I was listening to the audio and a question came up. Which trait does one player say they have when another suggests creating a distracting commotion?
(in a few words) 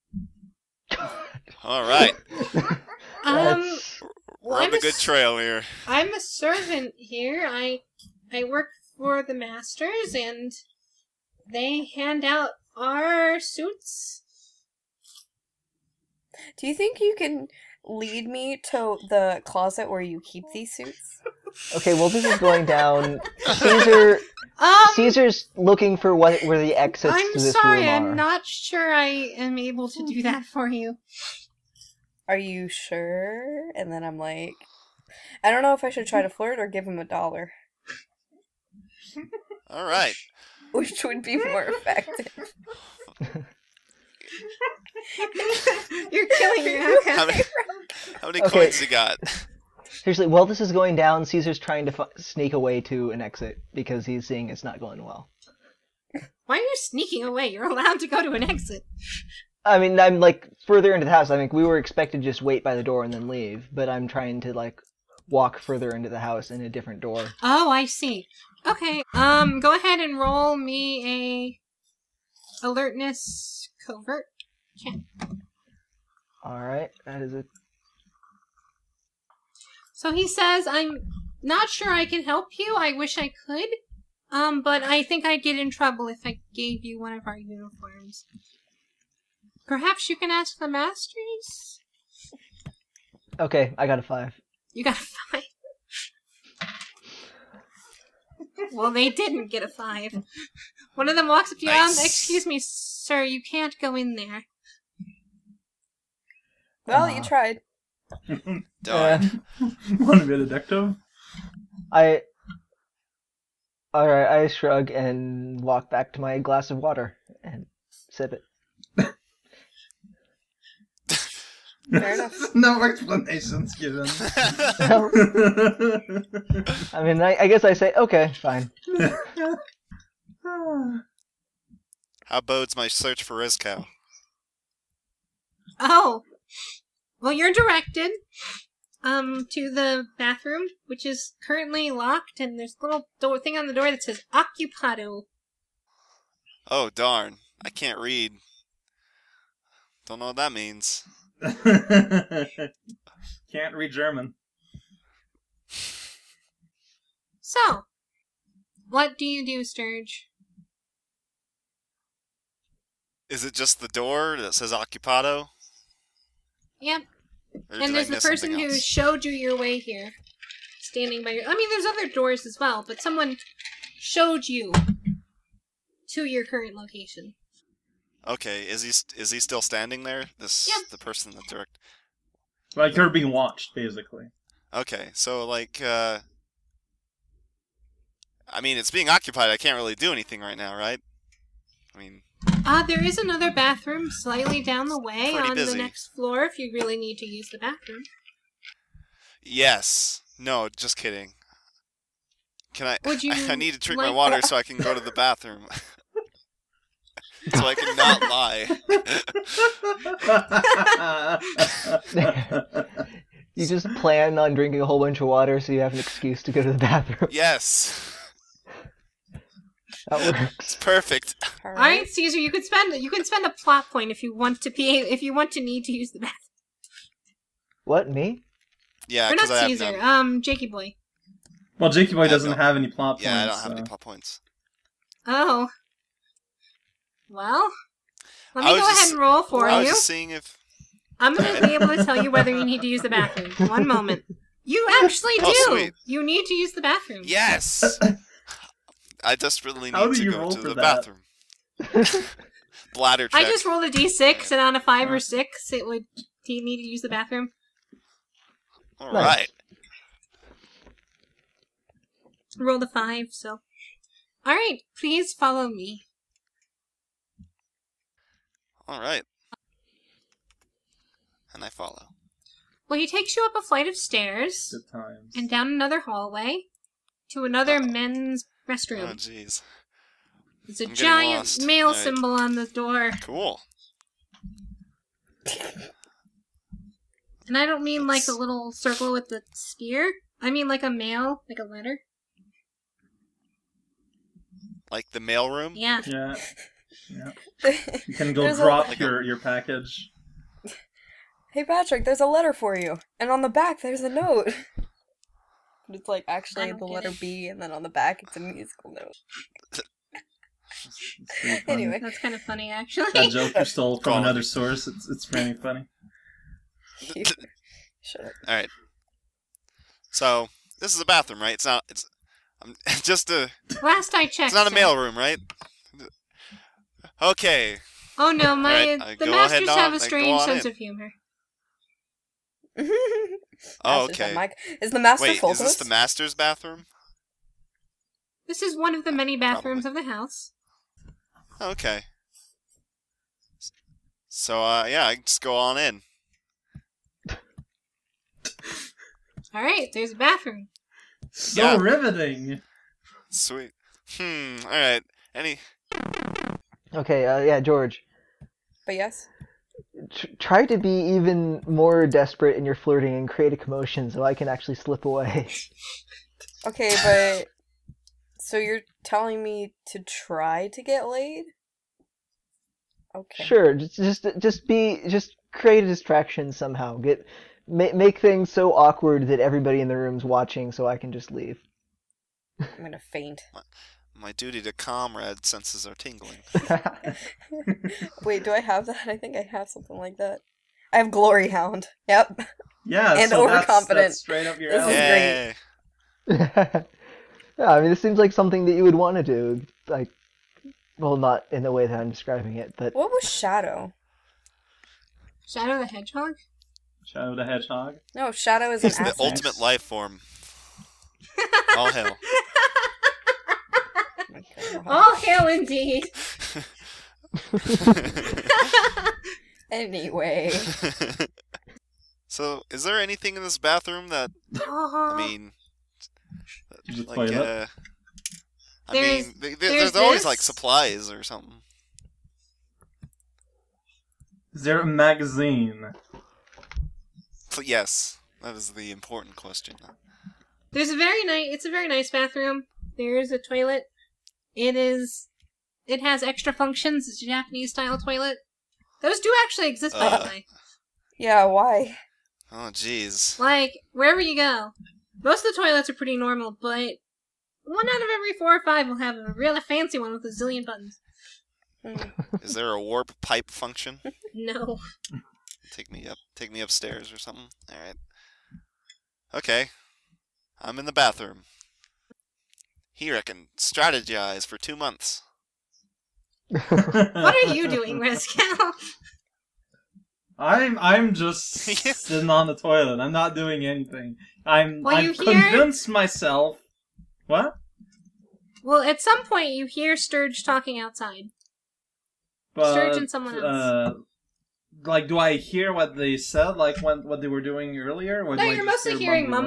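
glory hound.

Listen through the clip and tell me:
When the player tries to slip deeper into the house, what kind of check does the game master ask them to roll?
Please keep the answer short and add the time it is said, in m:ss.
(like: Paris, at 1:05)
alertness covert check, at 1:12.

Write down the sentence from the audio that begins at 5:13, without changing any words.
That joke you stole from another source.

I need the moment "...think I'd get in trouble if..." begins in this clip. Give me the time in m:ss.
1:25.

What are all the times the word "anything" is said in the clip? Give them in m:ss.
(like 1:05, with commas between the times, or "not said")
3:10, 7:02, 8:03.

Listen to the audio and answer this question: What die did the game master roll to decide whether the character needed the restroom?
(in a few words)
d6.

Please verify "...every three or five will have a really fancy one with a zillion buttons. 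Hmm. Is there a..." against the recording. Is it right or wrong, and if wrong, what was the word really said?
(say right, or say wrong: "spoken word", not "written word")
wrong: "four", not "three".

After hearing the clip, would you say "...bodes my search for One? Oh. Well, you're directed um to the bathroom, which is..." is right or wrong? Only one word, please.
wrong.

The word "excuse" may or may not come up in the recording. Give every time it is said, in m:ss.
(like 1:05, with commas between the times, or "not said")
1:41, 3:35.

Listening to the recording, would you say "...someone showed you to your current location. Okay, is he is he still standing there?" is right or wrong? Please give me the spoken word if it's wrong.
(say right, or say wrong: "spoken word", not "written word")
right.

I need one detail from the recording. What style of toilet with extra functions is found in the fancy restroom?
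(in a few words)
Japanese style.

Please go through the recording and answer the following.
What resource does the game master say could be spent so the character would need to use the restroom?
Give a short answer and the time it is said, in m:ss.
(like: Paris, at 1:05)
plot point, at 3:43.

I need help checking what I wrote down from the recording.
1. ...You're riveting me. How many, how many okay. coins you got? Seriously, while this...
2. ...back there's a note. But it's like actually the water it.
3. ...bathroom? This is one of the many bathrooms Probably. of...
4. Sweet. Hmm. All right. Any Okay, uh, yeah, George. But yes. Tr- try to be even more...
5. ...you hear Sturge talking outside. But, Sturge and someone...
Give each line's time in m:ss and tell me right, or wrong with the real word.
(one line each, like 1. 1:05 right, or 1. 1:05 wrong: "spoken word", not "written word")
1. 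0:46 wrong: "killing", not "riveting"
2. 5:03 wrong: "letter", not "water"
3. 5:36 right
4. 5:53 right
5. 8:09 right.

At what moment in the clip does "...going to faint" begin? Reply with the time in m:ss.
6:22.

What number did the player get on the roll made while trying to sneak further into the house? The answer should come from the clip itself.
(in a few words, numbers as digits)
5.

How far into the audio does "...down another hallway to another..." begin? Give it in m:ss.
4:35.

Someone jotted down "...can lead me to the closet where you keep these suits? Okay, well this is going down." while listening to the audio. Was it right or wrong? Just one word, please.
right.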